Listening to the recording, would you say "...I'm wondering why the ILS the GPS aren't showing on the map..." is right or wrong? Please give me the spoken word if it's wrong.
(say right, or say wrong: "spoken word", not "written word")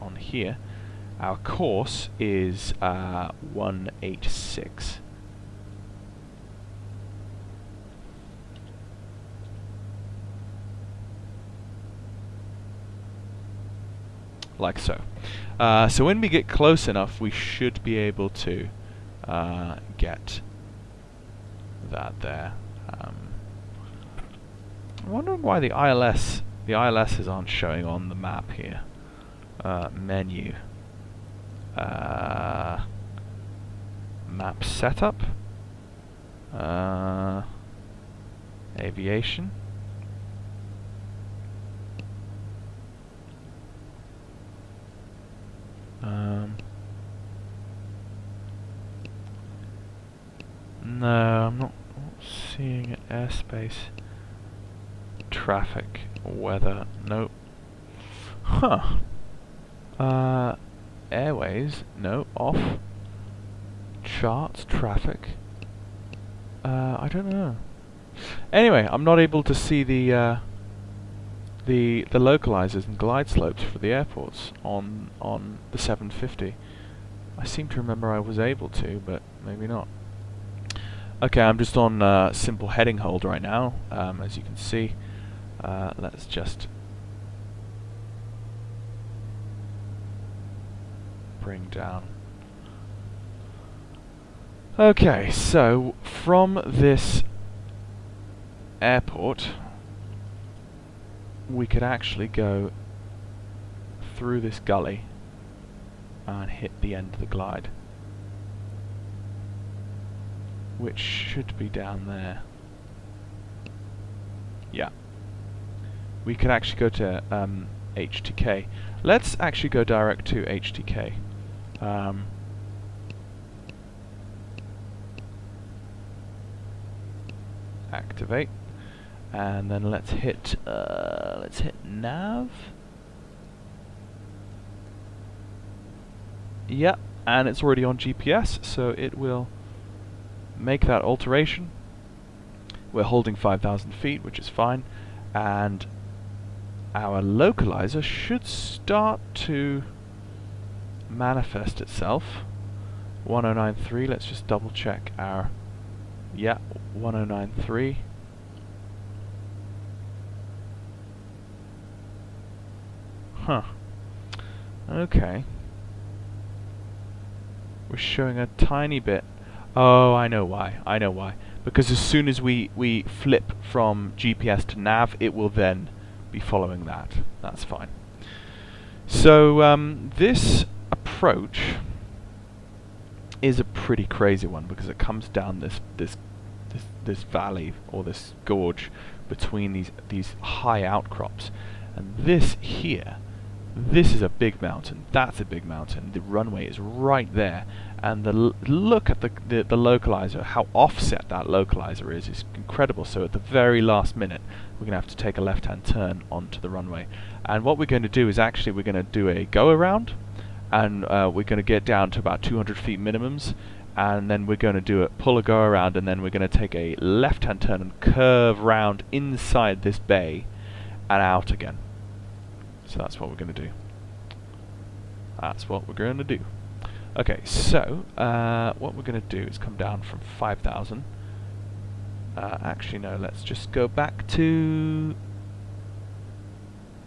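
wrong: "ILSs", not "GPS".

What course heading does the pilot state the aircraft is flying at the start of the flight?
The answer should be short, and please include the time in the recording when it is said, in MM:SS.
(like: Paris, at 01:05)
186, at 00:03.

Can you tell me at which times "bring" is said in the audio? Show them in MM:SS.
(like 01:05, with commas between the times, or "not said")
01:31.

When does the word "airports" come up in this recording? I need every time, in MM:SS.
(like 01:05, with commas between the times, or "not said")
01:13, 01:38.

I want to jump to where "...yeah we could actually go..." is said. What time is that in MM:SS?
01:54.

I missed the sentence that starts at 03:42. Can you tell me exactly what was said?
So that's what we're going to do.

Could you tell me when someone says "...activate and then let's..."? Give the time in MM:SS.
02:07.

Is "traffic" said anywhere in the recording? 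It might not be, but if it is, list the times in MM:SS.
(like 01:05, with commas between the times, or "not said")
00:55, 01:04.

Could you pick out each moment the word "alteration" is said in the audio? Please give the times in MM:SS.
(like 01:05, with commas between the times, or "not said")
02:21.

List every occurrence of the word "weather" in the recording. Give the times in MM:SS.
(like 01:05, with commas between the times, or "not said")
00:56.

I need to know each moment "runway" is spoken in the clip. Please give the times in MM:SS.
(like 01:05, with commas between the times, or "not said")
03:16, 03:26.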